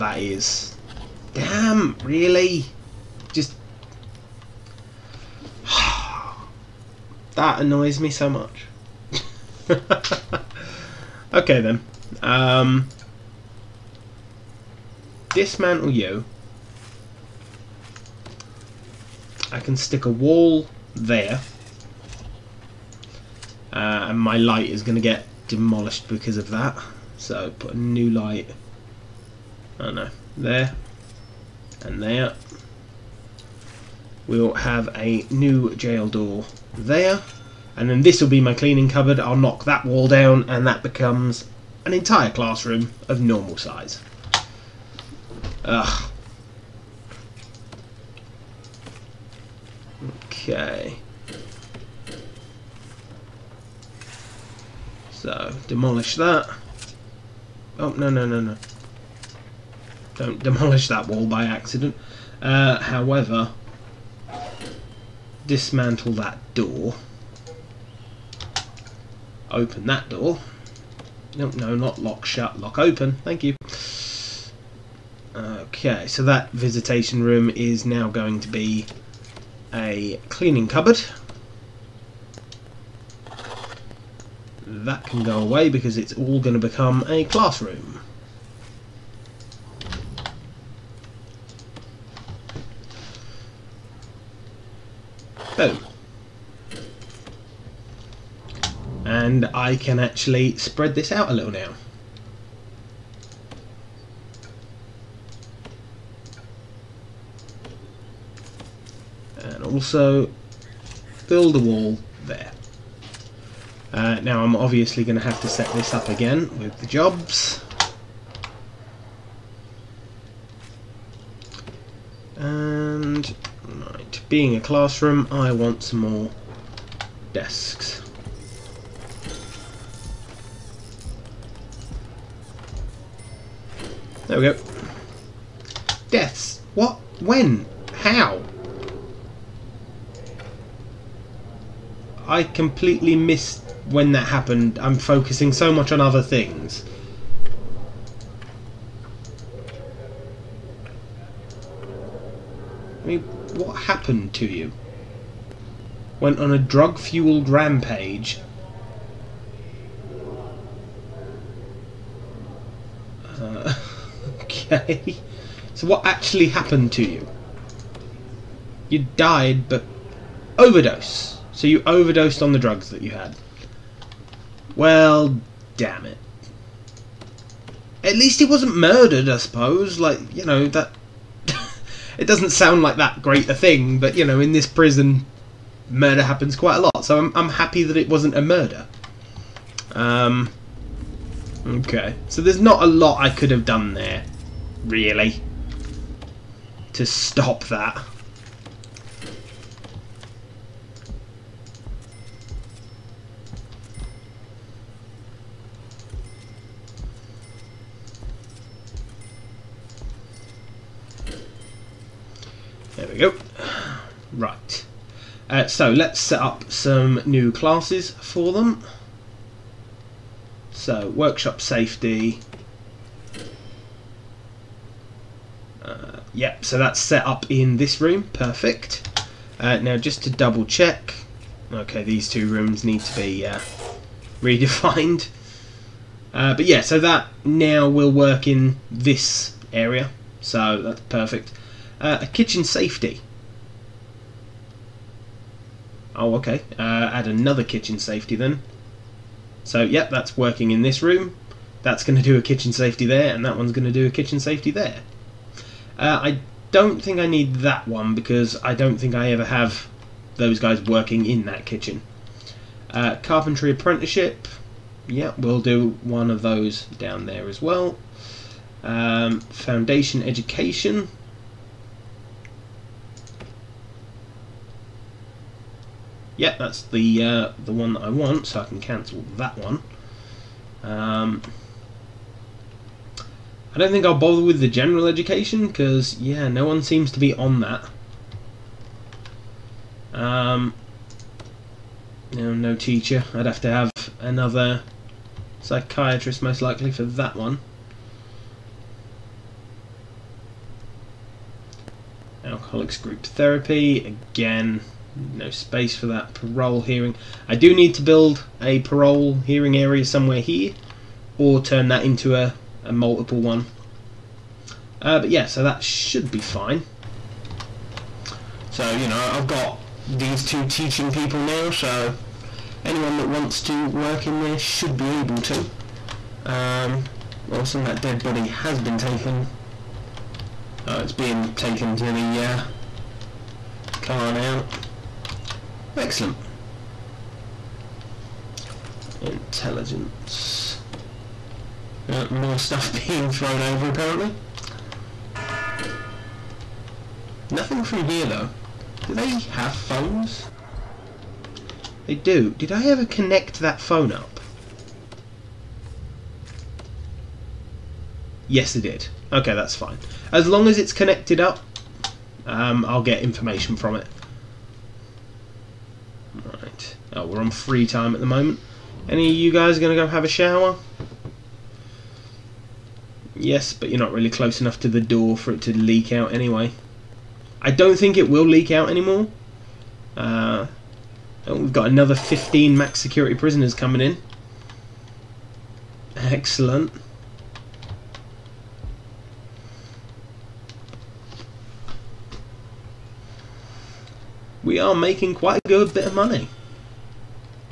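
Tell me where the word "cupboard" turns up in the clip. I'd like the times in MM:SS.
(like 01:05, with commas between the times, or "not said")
00:38, 01:20.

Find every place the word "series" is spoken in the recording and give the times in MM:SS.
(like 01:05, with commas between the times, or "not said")
not said.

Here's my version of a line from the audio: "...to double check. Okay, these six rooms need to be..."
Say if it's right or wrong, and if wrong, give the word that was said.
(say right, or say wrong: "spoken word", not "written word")
wrong: "two", not "six".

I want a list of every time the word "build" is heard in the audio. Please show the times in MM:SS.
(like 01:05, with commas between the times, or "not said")
01:51, 05:08.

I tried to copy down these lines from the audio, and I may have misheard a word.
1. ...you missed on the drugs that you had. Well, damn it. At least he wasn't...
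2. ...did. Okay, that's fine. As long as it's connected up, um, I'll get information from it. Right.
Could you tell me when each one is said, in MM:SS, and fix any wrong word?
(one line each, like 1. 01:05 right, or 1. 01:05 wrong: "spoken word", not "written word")
1. 02:51 wrong: "overdosed", not "missed"
2. 05:58 right.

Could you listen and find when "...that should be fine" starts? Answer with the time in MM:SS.
05:15.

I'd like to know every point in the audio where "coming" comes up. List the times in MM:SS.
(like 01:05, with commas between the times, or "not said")
06:23.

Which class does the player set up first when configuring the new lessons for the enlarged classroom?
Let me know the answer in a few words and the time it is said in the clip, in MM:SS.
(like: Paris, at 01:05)
Workshop safety, at 03:41.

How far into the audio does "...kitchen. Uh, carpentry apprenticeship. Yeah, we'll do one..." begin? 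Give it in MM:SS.
04:21.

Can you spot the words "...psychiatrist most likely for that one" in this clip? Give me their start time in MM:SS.
04:55.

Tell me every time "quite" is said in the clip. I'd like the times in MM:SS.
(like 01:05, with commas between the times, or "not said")
03:06, 06:35.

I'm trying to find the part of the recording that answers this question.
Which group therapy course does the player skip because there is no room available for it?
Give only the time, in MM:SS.
05:02.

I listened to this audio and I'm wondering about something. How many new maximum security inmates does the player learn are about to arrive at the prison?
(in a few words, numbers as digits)
15.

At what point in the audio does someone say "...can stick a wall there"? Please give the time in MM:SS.
00:19.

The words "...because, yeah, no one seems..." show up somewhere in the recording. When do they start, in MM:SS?
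04:45.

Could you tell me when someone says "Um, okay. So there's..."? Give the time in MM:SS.
03:09.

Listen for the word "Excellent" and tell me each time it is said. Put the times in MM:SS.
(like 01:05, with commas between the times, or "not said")
05:35, 06:26.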